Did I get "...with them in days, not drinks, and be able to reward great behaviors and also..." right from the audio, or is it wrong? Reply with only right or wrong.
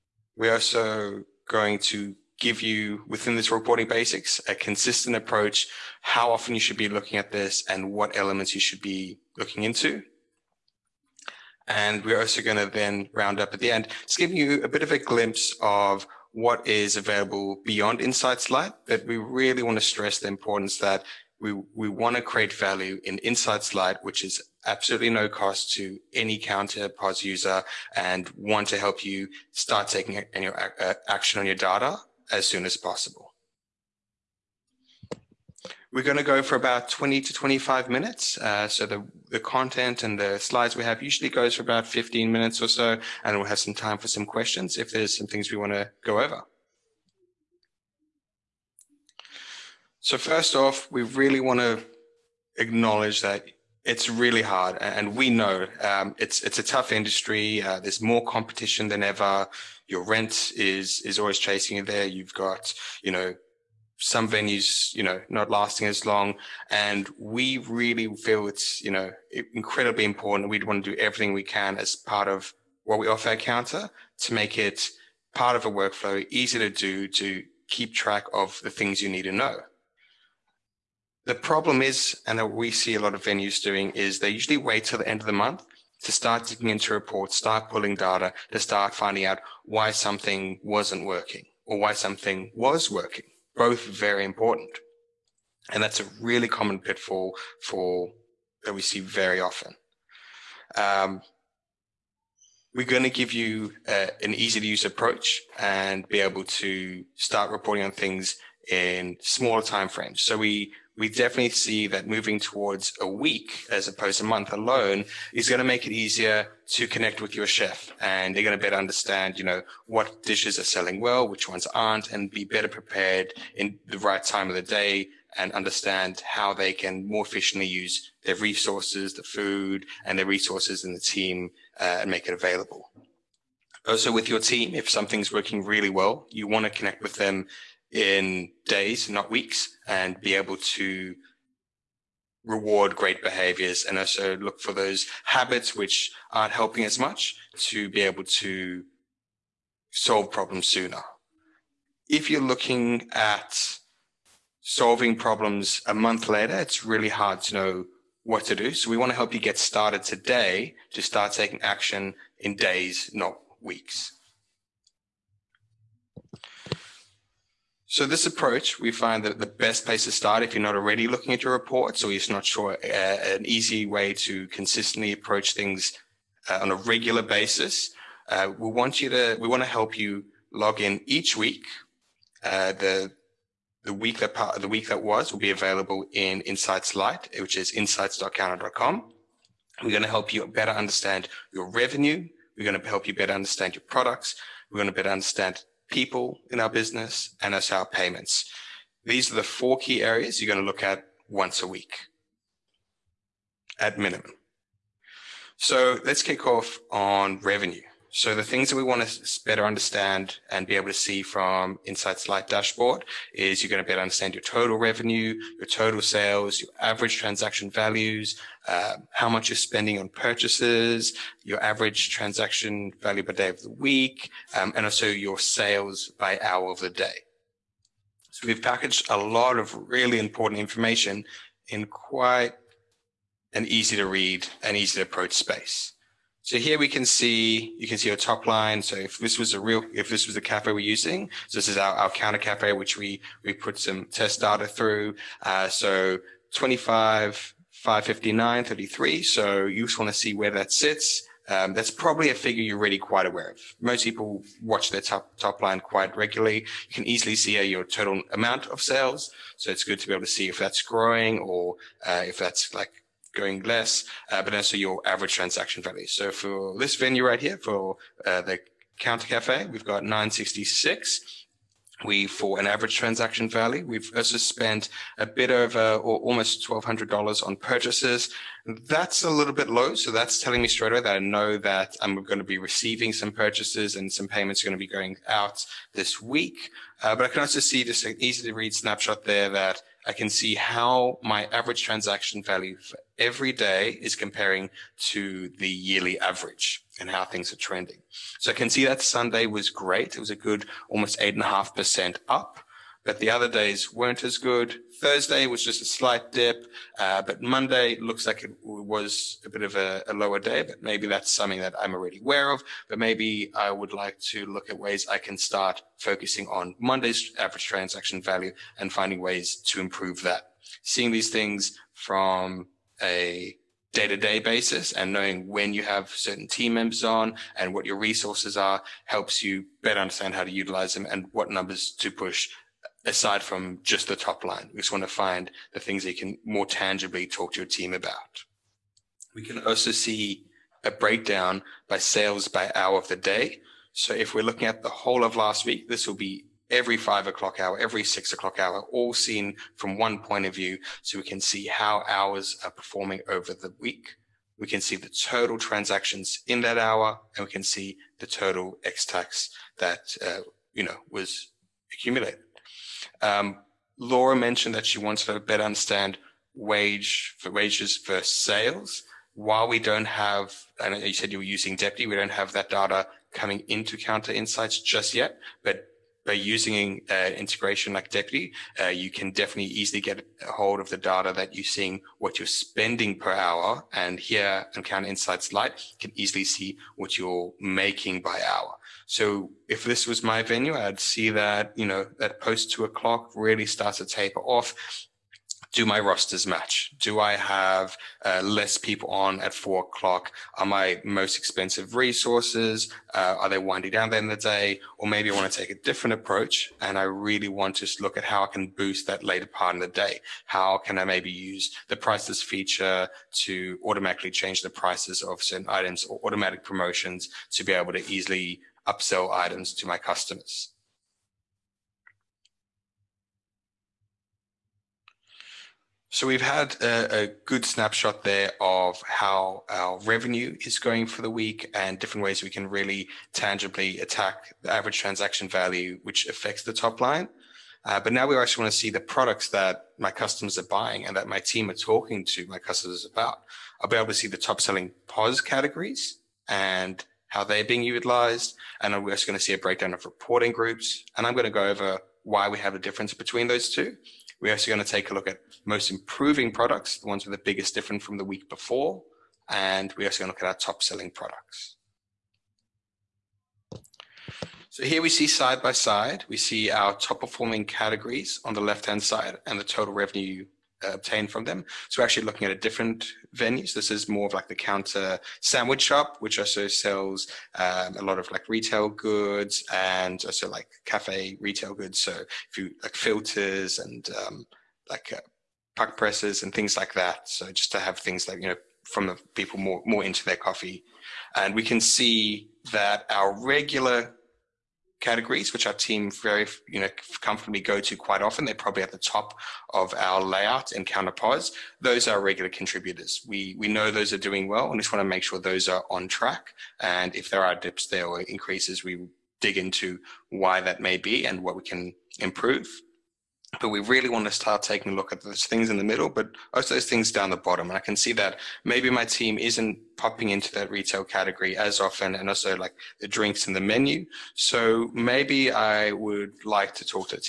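wrong.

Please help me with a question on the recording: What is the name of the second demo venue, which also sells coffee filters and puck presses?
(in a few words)
Kounta sandwich shop.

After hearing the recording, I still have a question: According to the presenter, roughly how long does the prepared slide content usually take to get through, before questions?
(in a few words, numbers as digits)
15 minutes.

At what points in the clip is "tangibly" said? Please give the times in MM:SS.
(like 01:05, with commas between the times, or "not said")
05:36, 07:13.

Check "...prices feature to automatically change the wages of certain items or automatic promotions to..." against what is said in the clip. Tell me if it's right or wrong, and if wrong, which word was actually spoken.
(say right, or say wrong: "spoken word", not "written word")
wrong: "prices", not "wages".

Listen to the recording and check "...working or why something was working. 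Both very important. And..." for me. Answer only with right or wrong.
right.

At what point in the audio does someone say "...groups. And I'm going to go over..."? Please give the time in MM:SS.
07:30.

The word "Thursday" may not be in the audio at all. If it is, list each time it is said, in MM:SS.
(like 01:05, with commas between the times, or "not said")
05:05.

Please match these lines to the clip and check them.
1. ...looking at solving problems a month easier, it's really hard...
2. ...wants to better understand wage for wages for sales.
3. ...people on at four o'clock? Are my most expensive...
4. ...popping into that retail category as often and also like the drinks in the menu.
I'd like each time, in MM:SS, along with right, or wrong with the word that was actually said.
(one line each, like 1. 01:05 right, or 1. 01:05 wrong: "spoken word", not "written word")
1. 02:32 wrong: "later", not "easier"
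2. 06:04 right
3. 06:38 right
4. 08:39 right.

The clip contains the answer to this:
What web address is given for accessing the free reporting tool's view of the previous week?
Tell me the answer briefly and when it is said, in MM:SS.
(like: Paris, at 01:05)
insights.kounta.com, at 03:07.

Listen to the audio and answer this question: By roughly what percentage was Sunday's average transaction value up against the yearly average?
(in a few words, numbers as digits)
8.5%.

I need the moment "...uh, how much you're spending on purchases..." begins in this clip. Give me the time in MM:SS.
03:38.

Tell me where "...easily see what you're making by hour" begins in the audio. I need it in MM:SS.
06:26.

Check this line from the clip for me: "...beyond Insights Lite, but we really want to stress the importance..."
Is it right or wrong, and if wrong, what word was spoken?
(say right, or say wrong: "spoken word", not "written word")
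right.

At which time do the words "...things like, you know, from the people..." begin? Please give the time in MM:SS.
08:07.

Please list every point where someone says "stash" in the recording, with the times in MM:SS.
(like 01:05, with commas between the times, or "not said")
not said.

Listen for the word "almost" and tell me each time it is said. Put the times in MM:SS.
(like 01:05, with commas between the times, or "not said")
04:36, 05:00.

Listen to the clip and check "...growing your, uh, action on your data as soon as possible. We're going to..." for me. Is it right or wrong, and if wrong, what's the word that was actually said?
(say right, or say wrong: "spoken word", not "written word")
wrong: "taking", not "growing".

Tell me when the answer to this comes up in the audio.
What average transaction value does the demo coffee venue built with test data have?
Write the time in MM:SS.
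04:30.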